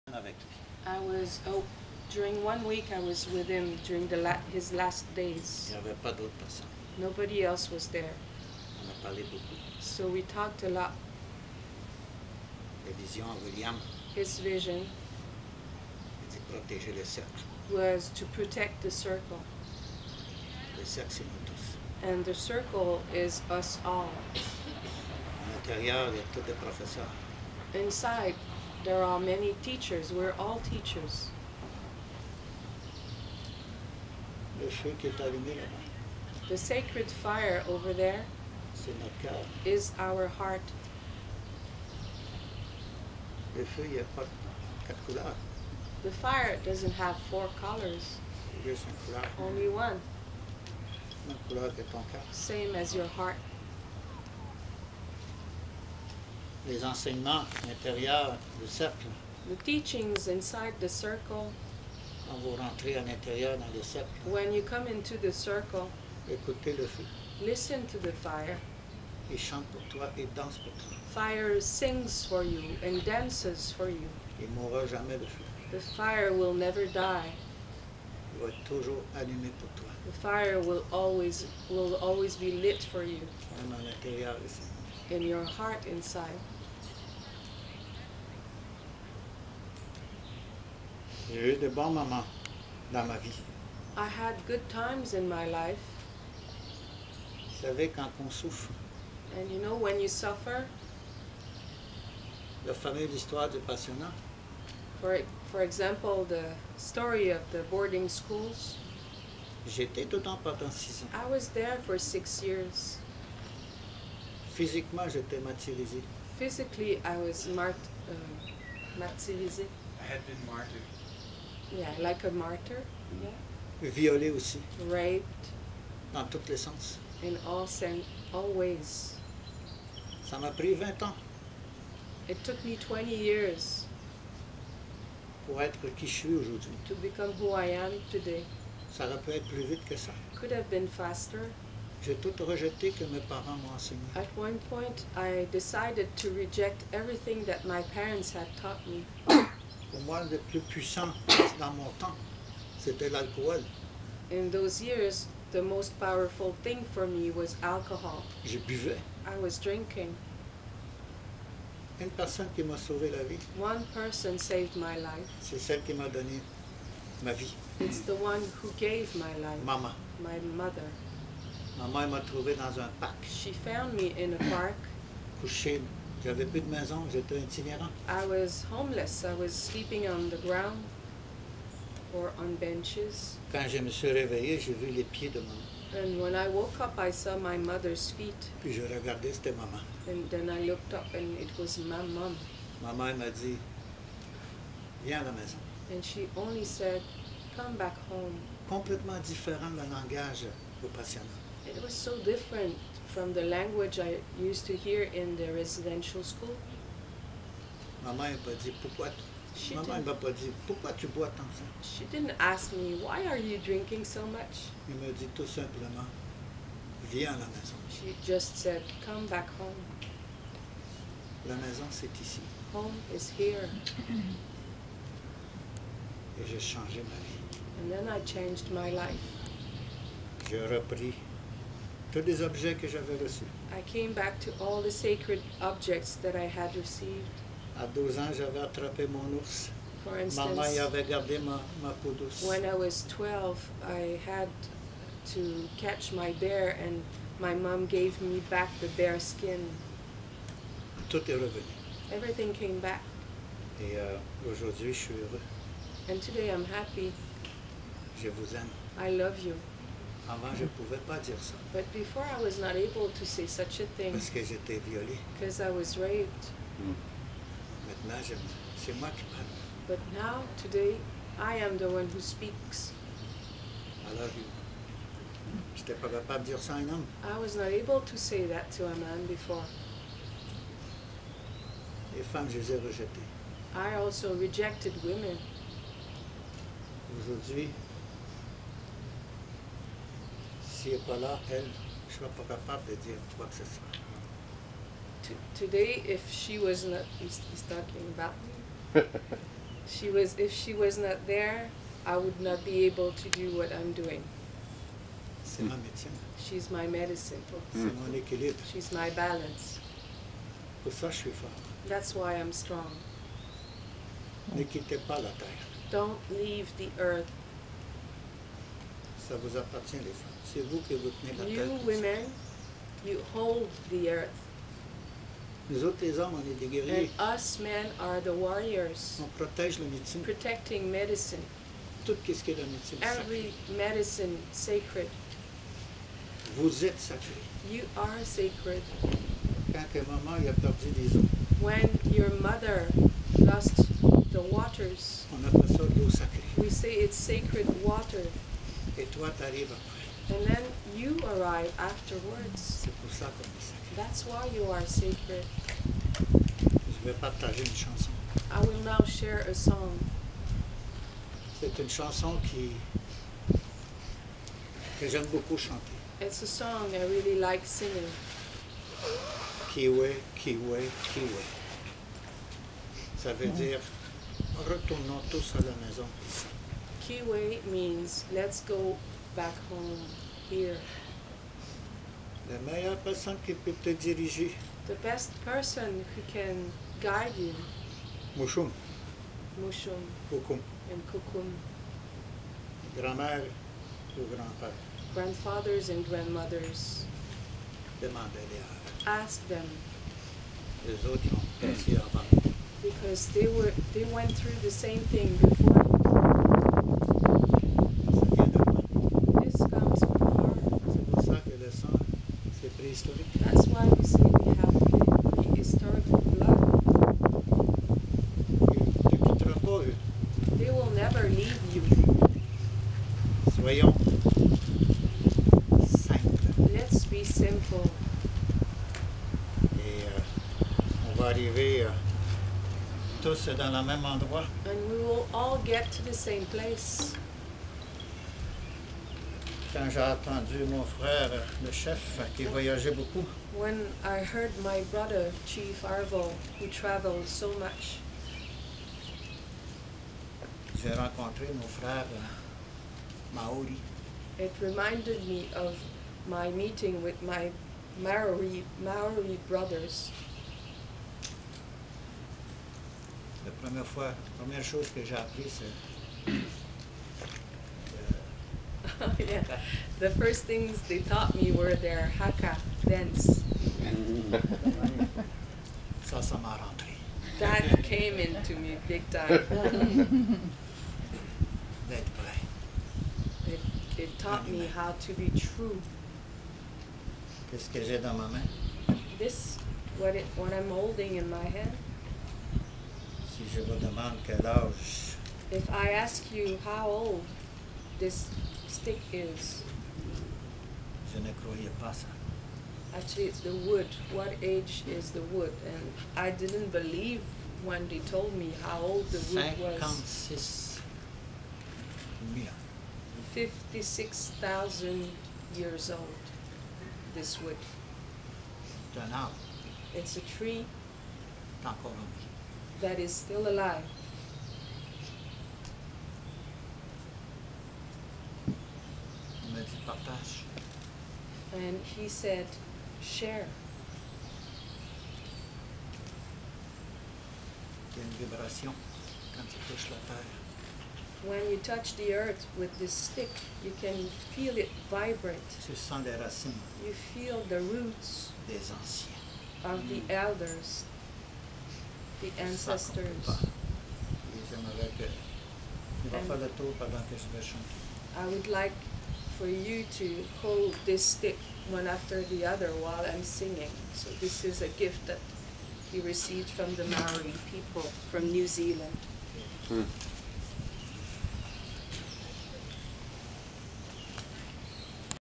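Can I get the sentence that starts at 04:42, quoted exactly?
Les femmes, je les ai rejetées.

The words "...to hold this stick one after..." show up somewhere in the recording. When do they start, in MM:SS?
09:19.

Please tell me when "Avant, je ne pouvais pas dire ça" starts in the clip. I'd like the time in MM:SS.
04:20.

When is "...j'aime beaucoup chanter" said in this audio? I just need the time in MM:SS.
06:05.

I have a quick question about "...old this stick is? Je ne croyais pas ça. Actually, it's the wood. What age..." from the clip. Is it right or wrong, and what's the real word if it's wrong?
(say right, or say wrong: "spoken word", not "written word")
right.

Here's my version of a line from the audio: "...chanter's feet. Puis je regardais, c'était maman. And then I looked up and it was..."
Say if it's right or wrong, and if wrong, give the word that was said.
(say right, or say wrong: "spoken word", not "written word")
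wrong: "mother", not "chanter".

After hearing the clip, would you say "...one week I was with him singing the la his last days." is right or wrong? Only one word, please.
wrong.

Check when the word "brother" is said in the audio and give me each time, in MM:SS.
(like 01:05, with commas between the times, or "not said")
07:24, 07:39.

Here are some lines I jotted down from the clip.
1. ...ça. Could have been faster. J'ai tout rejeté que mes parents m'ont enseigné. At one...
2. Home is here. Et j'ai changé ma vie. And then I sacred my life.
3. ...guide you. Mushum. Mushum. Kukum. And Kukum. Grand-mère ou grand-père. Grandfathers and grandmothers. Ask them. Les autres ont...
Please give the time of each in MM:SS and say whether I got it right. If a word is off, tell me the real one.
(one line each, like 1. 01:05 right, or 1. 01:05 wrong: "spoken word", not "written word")
1. 02:19 right
2. 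03:42 wrong: "changed", not "sacred"
3. 06:27 right.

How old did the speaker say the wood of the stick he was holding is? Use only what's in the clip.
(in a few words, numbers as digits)
56,000 years.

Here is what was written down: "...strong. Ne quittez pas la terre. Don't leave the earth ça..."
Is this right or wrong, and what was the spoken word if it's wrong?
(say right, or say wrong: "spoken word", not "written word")
right.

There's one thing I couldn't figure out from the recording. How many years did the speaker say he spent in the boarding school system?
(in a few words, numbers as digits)
6.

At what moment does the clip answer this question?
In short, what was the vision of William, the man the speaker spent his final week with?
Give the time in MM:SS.
00:17.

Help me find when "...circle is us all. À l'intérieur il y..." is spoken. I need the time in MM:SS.
00:22.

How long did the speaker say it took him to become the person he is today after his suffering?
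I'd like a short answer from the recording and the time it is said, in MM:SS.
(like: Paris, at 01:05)
20 years, at 02:12.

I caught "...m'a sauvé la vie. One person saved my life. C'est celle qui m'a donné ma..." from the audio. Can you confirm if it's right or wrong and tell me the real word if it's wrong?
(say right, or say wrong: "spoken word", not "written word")
right.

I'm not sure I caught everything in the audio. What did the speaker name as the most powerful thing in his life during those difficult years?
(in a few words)
Alcohol.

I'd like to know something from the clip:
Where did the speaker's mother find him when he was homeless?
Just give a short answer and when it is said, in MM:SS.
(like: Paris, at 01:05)
In a park, at 02:54.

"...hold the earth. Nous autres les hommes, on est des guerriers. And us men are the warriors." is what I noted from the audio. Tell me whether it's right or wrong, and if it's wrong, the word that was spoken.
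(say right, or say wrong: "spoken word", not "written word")
right.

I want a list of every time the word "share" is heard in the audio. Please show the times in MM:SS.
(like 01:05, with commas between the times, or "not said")
05:59, 08:53.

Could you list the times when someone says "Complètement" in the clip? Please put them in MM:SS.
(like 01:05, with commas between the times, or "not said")
03:18.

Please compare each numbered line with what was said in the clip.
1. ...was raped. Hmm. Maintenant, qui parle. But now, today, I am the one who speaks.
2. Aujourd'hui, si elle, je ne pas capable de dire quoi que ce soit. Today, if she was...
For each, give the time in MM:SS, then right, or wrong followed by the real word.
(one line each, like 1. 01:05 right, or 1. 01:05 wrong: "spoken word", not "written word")
1. 04:25 right
2. 04:47 right.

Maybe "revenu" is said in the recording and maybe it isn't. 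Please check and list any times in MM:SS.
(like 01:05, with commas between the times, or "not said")
04:11.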